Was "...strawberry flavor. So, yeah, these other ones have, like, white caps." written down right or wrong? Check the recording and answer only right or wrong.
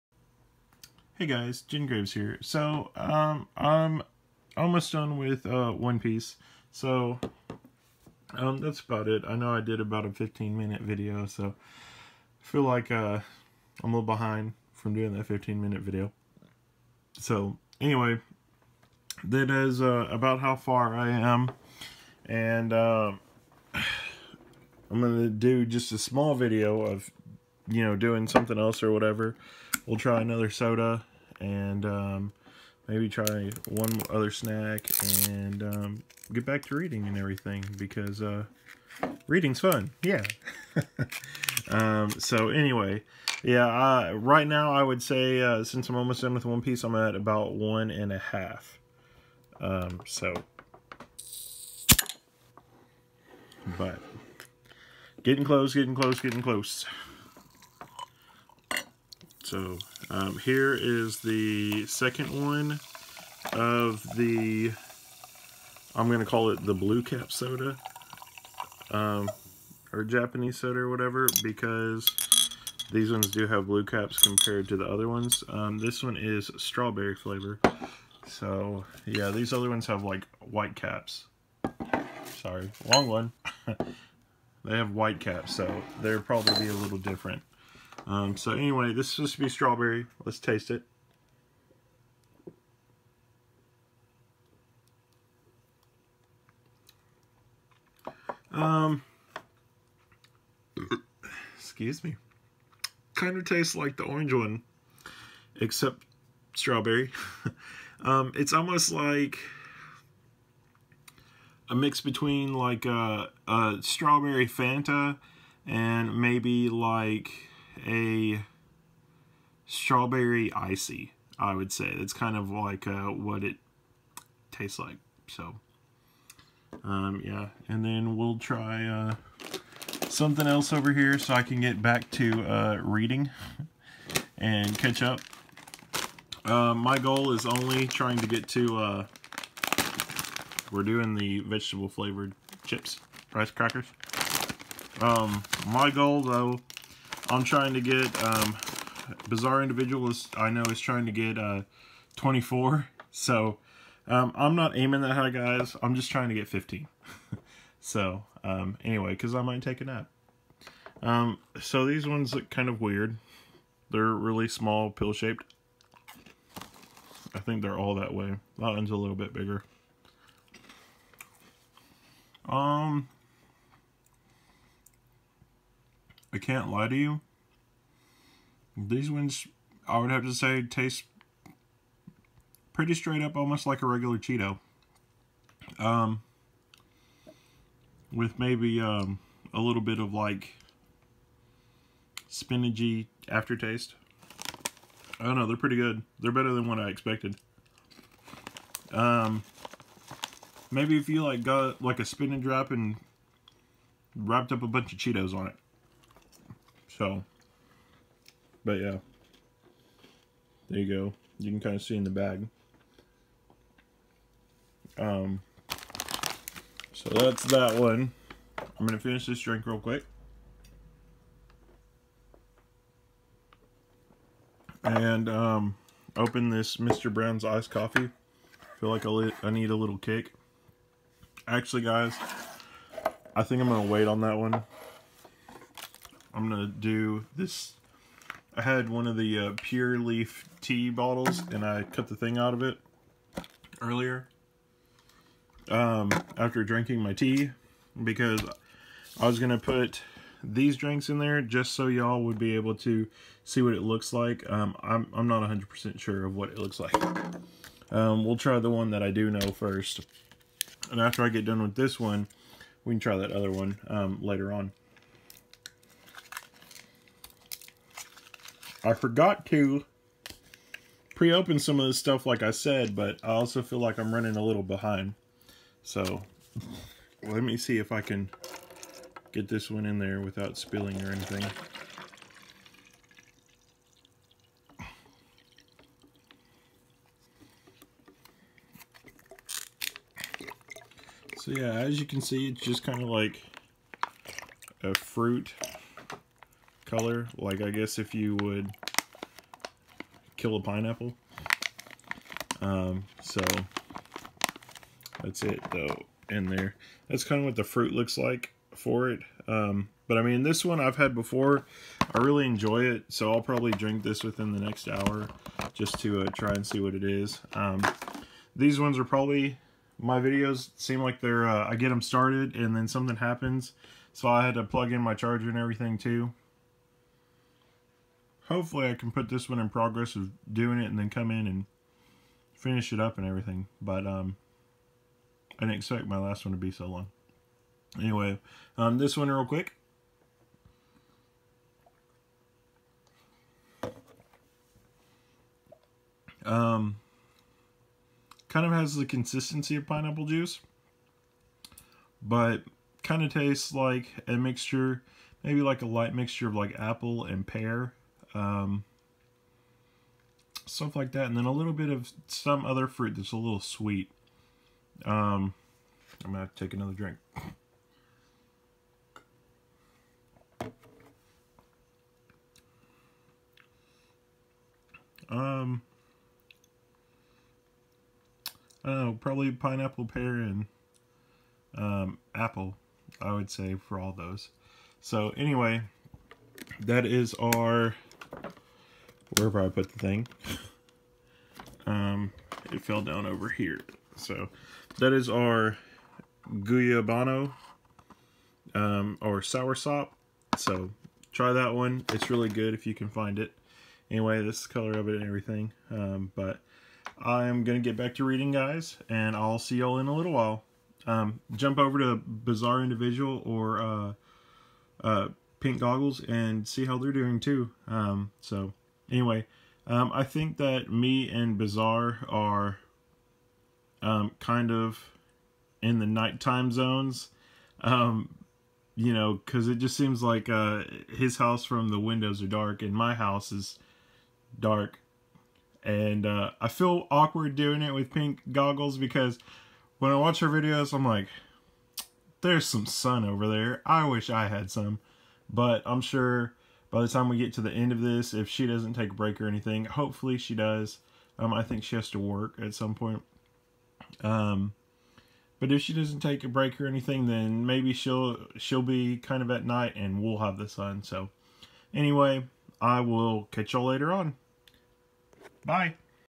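right.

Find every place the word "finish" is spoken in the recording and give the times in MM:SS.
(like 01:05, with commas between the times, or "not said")
03:38, 05:32.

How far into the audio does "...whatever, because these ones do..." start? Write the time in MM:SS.
01:10.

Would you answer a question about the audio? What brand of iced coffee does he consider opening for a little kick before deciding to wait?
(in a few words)
Mr. Brown's.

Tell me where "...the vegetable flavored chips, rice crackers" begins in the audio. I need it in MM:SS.
02:21.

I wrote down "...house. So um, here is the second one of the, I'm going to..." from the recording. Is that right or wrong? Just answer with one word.
wrong.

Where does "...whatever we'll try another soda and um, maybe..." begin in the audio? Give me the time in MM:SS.
00:28.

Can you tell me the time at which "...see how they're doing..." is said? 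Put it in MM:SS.
06:56.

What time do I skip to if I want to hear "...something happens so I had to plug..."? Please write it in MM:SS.
05:22.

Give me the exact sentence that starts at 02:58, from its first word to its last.
These ones, I would have to say, taste pretty straight up, almost like a regular Cheeto.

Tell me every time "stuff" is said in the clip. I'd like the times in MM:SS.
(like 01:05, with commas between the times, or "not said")
04:31, 06:00.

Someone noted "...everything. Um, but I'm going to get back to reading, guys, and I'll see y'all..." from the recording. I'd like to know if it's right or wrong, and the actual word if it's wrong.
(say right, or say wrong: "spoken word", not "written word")
right.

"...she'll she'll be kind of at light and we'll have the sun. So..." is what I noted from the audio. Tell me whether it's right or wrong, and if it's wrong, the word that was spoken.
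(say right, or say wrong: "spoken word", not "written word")
wrong: "night", not "light".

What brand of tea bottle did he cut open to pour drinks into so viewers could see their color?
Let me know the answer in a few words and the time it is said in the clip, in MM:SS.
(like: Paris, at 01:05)
Pure Leaf, at 03:59.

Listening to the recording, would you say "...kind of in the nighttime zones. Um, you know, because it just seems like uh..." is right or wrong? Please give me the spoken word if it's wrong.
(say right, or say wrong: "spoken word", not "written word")
right.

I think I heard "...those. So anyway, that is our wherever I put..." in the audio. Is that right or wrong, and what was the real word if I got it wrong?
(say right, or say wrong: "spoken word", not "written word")
right.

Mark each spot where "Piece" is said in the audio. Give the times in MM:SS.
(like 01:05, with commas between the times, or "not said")
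00:05, 00:46.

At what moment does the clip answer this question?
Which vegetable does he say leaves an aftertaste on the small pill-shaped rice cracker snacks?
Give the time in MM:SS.
03:12.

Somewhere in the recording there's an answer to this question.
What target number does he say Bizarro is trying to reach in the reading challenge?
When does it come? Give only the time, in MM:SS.
02:32.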